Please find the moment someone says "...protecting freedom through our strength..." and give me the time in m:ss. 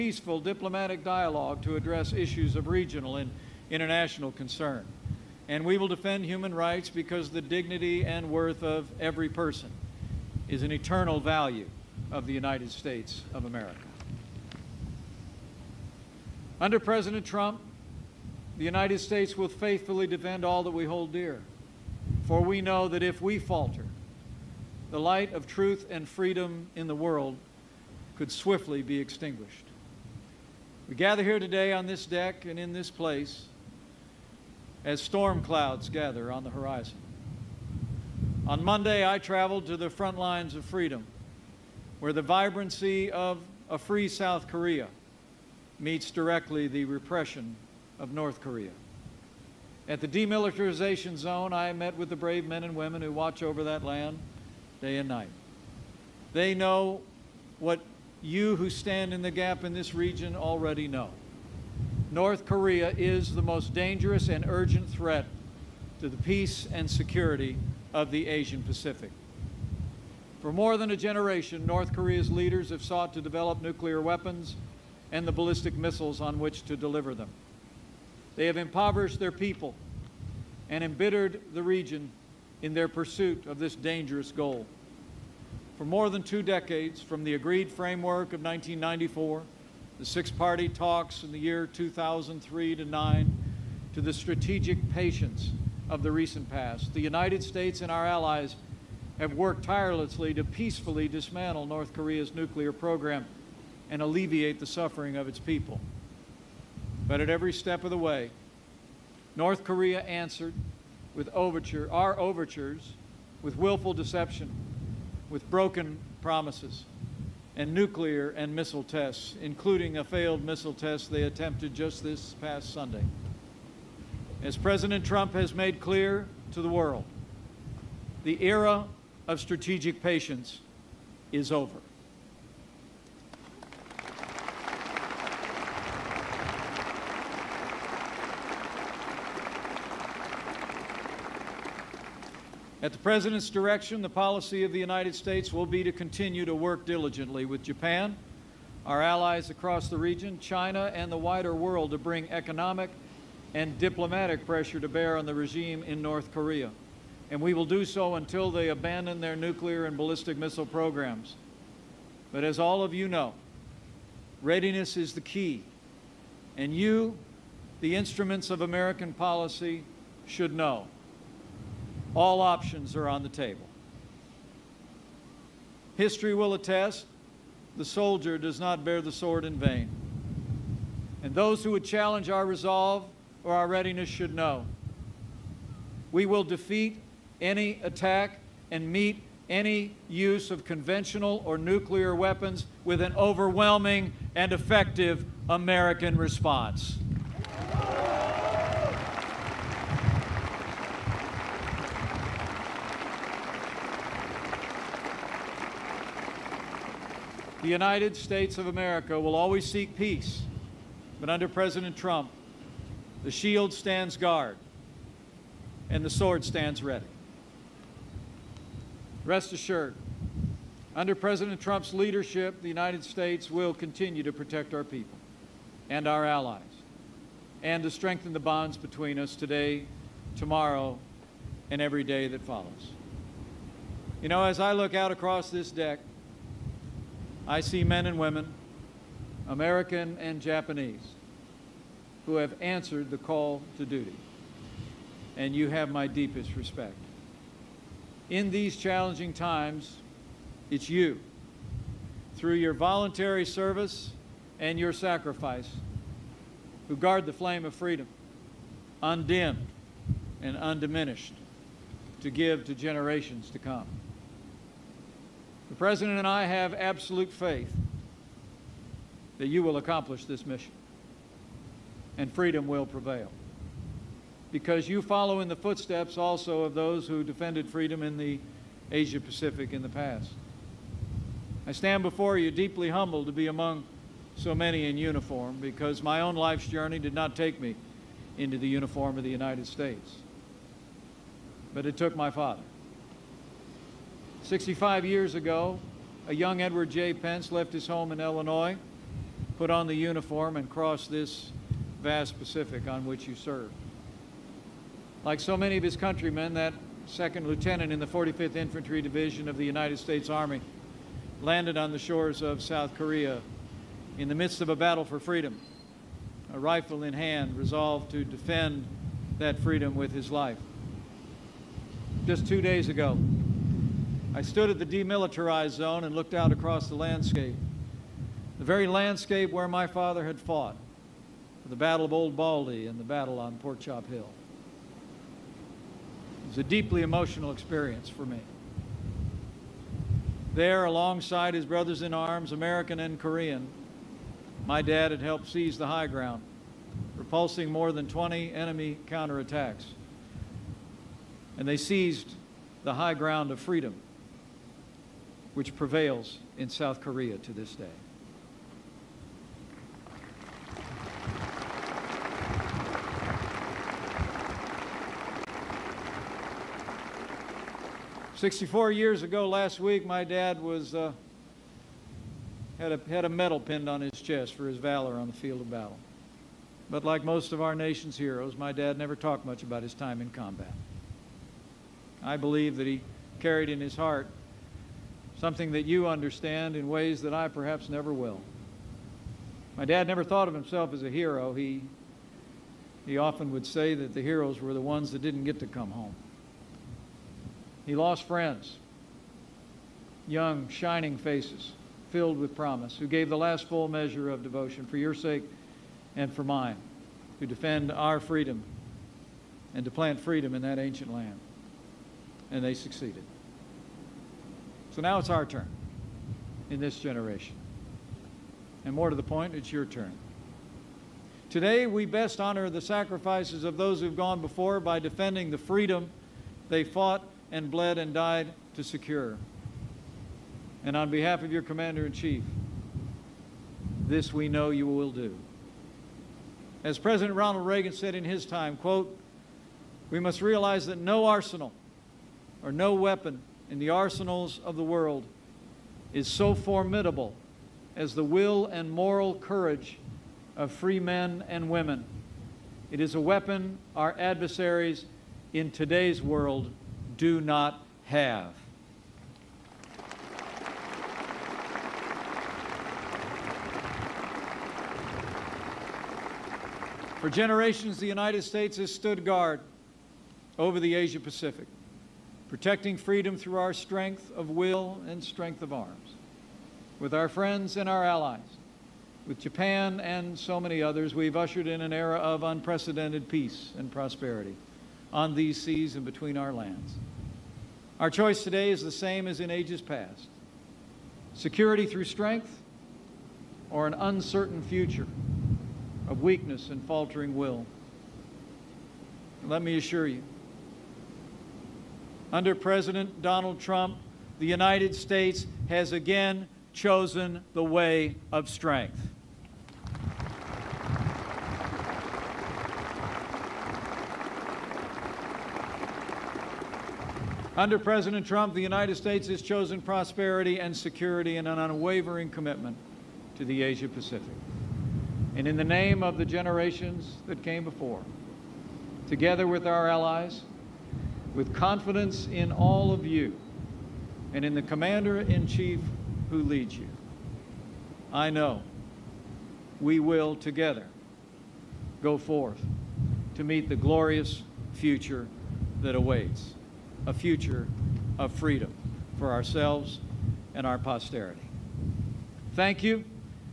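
7:52.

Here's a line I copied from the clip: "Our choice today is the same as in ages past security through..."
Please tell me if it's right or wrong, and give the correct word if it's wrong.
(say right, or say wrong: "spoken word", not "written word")
right.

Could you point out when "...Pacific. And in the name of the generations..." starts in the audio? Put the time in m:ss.
8:43.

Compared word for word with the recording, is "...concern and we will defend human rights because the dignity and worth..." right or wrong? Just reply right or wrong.
right.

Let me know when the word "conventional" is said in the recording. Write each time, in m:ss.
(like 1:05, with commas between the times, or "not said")
3:10.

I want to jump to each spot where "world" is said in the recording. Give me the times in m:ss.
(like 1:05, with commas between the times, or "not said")
0:26, 2:06, 2:31, 7:24, 7:36.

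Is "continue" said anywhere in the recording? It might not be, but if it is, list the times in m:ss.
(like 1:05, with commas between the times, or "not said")
2:25, 3:43.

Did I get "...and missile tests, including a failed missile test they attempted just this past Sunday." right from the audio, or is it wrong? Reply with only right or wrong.
right.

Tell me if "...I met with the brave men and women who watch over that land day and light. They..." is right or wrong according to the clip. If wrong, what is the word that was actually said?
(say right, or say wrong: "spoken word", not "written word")
wrong: "night", not "light".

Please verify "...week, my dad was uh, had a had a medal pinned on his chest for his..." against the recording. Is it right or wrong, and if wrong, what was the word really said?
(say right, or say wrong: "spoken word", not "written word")
right.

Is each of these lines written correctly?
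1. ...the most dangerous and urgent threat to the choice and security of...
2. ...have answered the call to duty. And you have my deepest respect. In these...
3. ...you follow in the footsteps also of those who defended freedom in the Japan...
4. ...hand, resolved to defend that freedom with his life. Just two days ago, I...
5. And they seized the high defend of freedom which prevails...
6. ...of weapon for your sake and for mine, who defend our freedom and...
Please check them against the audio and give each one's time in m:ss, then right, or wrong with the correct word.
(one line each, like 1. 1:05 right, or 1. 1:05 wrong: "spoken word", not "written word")
1. 1:03 wrong: "peace", not "choice"
2. 4:02 right
3. 4:34 wrong: "Asia", not "Japan"
4. 5:17 right
5. 5:51 wrong: "ground", not "defend"
6. 6:44 wrong: "devotion", not "weapon".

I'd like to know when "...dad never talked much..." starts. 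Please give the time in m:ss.
6:18.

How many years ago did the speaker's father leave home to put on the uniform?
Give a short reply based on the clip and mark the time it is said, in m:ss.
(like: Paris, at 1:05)
65, at 4:54.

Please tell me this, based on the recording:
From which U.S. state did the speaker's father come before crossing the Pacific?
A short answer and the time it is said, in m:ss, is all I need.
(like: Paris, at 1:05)
Illinois, at 4:58.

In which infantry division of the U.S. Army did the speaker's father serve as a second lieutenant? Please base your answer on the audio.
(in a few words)
45th Infantry Division.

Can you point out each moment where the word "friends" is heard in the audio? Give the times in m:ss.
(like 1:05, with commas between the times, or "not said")
6:38, 7:57.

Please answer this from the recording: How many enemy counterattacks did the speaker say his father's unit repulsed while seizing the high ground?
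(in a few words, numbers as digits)
More than 20.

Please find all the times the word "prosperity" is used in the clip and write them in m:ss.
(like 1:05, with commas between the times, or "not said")
8:03, 8:39.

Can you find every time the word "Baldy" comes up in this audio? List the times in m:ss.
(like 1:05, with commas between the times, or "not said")
5:32.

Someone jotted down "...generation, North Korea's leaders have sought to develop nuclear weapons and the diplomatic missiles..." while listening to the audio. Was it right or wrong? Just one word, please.
wrong.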